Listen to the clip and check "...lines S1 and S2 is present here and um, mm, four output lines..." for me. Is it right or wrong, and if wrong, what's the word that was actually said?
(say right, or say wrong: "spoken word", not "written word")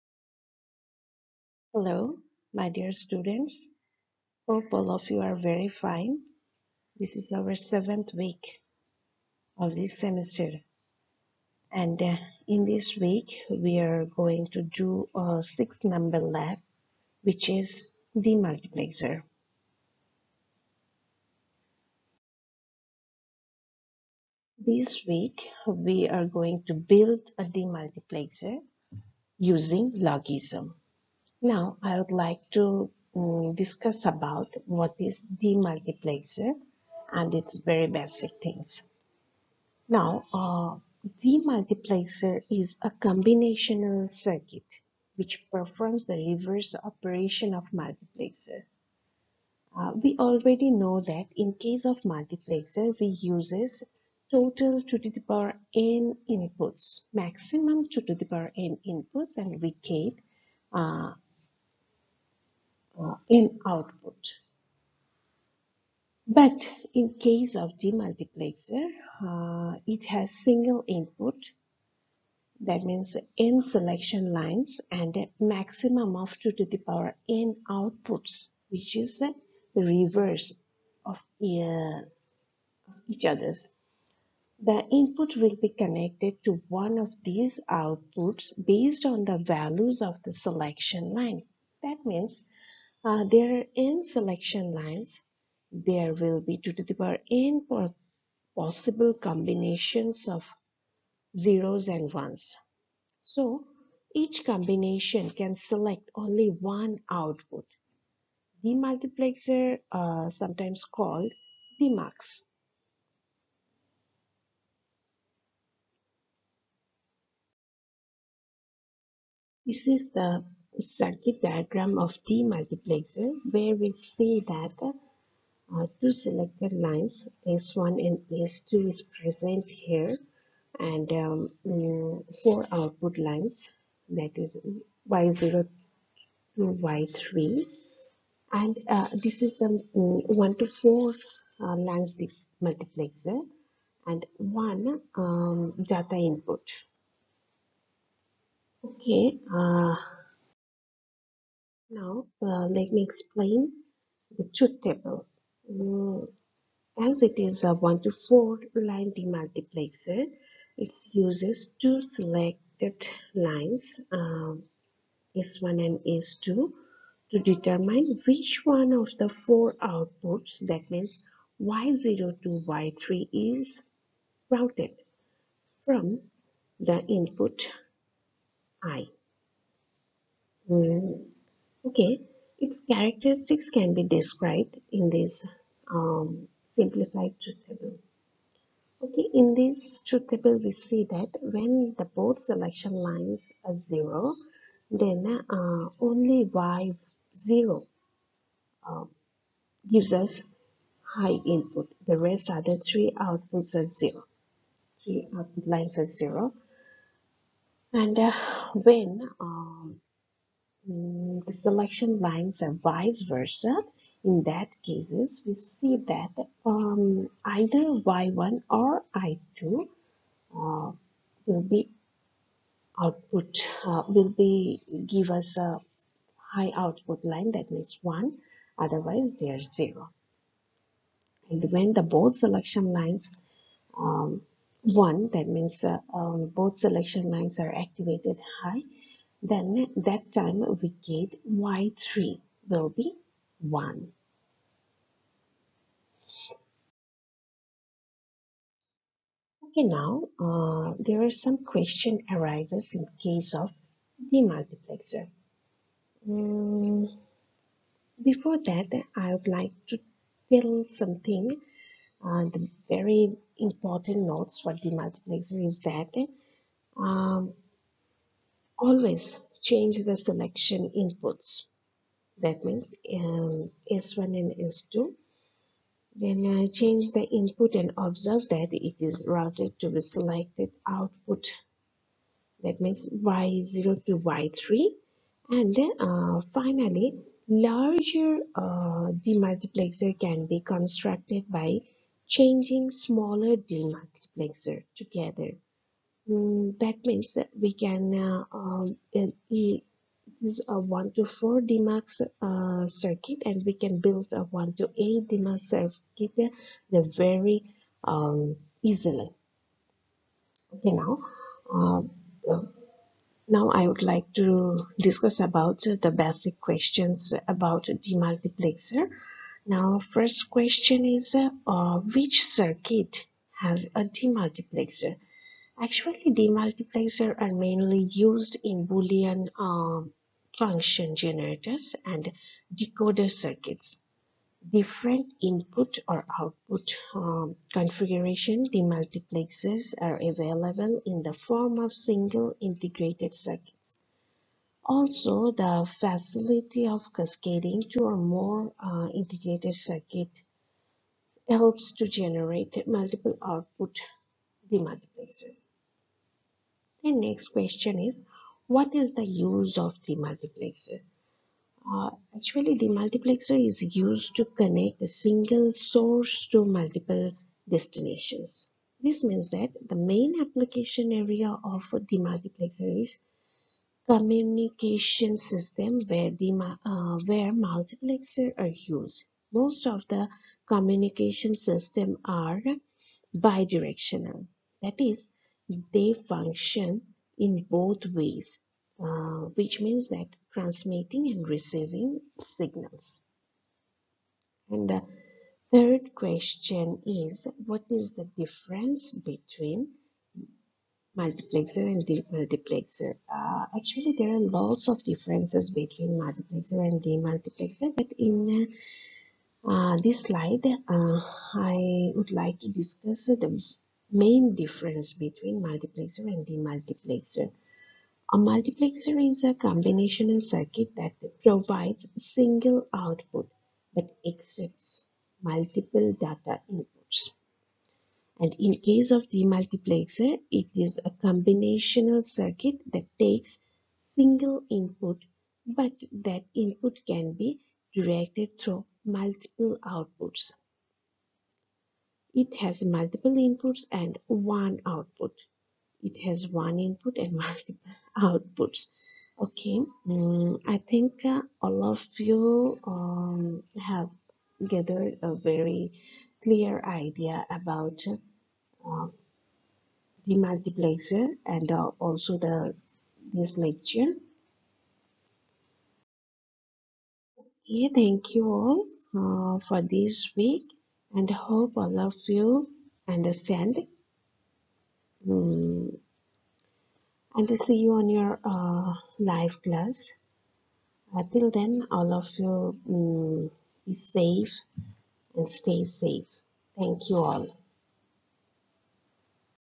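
right.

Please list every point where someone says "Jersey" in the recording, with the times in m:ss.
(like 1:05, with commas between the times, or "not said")
not said.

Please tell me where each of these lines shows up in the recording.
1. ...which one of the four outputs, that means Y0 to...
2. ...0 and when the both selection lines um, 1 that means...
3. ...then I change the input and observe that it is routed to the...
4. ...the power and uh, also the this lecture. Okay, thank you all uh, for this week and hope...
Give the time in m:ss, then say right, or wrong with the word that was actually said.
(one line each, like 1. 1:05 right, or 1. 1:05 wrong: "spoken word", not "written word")
1. 2:48 right
2. 3:49 right
3. 4:36 right
4. 7:40 wrong: "multiplexer", not "power".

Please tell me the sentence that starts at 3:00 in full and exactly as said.
Mm, Okay, its characteristics can be described in this um, simplified truth table.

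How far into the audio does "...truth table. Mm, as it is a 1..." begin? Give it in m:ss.
2:34.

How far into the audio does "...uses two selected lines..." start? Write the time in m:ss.
2:41.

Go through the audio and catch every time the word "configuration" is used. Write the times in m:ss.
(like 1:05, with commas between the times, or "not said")
5:37.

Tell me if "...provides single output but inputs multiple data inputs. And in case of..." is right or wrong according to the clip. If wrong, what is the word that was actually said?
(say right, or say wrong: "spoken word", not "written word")
wrong: "accepts", not "inputs".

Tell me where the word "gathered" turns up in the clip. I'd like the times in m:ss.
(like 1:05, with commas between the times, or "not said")
7:34.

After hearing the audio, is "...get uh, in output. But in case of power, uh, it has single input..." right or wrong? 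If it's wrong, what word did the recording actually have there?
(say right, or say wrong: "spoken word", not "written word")
wrong: "demultiplexer", not "power".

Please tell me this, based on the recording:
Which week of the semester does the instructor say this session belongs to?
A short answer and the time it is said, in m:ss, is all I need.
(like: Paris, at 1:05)
Seventh, at 0:07.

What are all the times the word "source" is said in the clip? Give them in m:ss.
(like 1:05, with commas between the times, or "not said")
6:05.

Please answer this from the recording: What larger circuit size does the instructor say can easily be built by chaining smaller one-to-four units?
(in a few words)
1 to 8.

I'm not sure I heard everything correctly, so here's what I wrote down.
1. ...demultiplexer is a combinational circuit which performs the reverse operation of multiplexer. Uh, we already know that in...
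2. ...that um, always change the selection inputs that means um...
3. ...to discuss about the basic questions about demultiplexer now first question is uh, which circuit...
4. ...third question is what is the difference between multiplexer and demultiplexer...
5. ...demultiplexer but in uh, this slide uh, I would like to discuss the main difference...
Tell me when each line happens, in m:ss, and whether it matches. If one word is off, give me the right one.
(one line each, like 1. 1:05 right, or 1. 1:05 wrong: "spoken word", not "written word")
1. 0:41 right
2. 4:25 right
3. 5:14 right
4. 6:35 right
5. 6:47 right.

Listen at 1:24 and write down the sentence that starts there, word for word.
The input will be connected to one of these outputs based on the values of the selection line.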